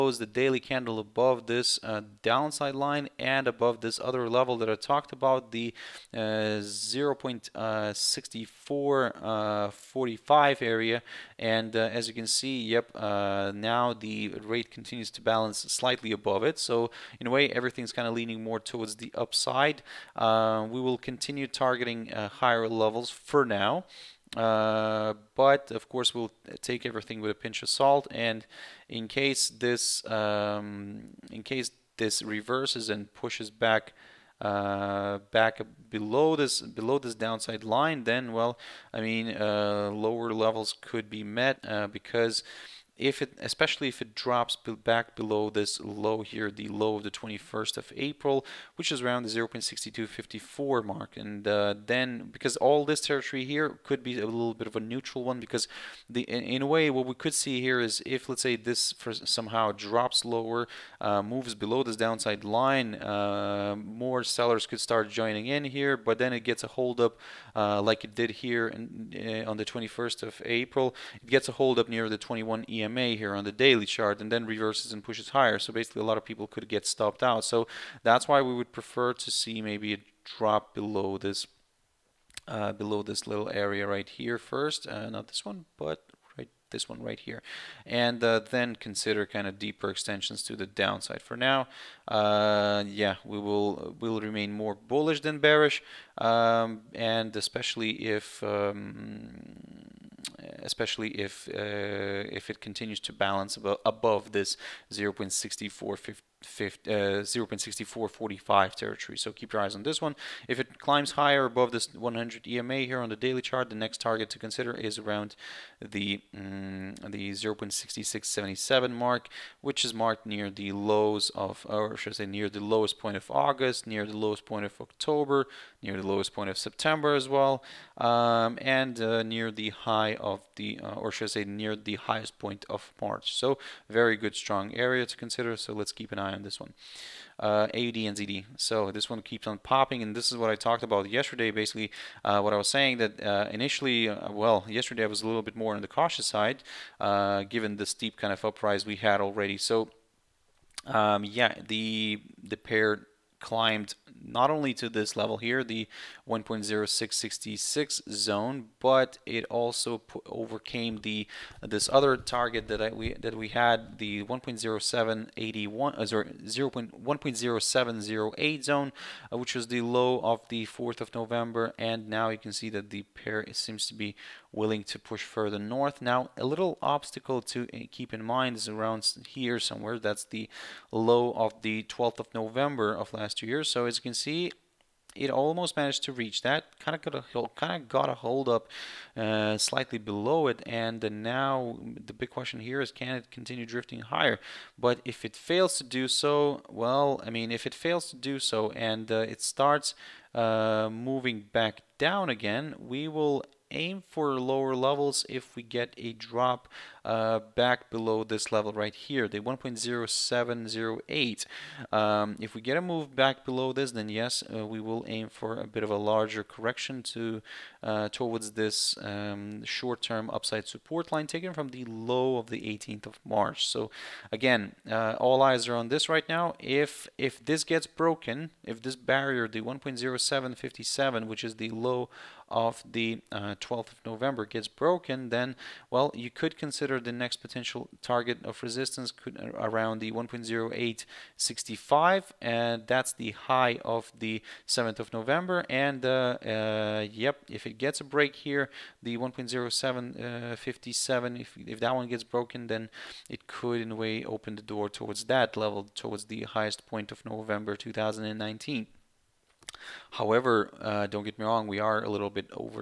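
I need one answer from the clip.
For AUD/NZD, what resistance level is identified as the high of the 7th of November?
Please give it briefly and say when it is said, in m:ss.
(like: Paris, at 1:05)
1.0865, at 4:00.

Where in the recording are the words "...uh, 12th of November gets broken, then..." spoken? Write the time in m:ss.
3:53.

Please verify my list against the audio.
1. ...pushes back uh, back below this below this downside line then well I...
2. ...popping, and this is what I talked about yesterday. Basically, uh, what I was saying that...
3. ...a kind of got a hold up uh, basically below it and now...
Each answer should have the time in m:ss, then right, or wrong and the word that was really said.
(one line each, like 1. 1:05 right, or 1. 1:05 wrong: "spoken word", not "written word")
1. 0:33 right
2. 2:19 right
3. 3:07 wrong: "slightly", not "basically".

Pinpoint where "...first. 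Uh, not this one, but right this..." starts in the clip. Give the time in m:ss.
1:24.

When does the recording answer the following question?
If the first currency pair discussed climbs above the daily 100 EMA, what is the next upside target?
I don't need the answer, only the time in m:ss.
1:57.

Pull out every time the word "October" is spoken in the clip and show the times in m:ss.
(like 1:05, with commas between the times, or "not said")
2:04.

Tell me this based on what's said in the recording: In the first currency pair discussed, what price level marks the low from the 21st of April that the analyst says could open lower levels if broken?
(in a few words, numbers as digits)
0.6254.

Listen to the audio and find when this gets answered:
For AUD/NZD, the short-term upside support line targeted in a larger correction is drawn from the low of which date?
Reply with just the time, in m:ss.
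3:42.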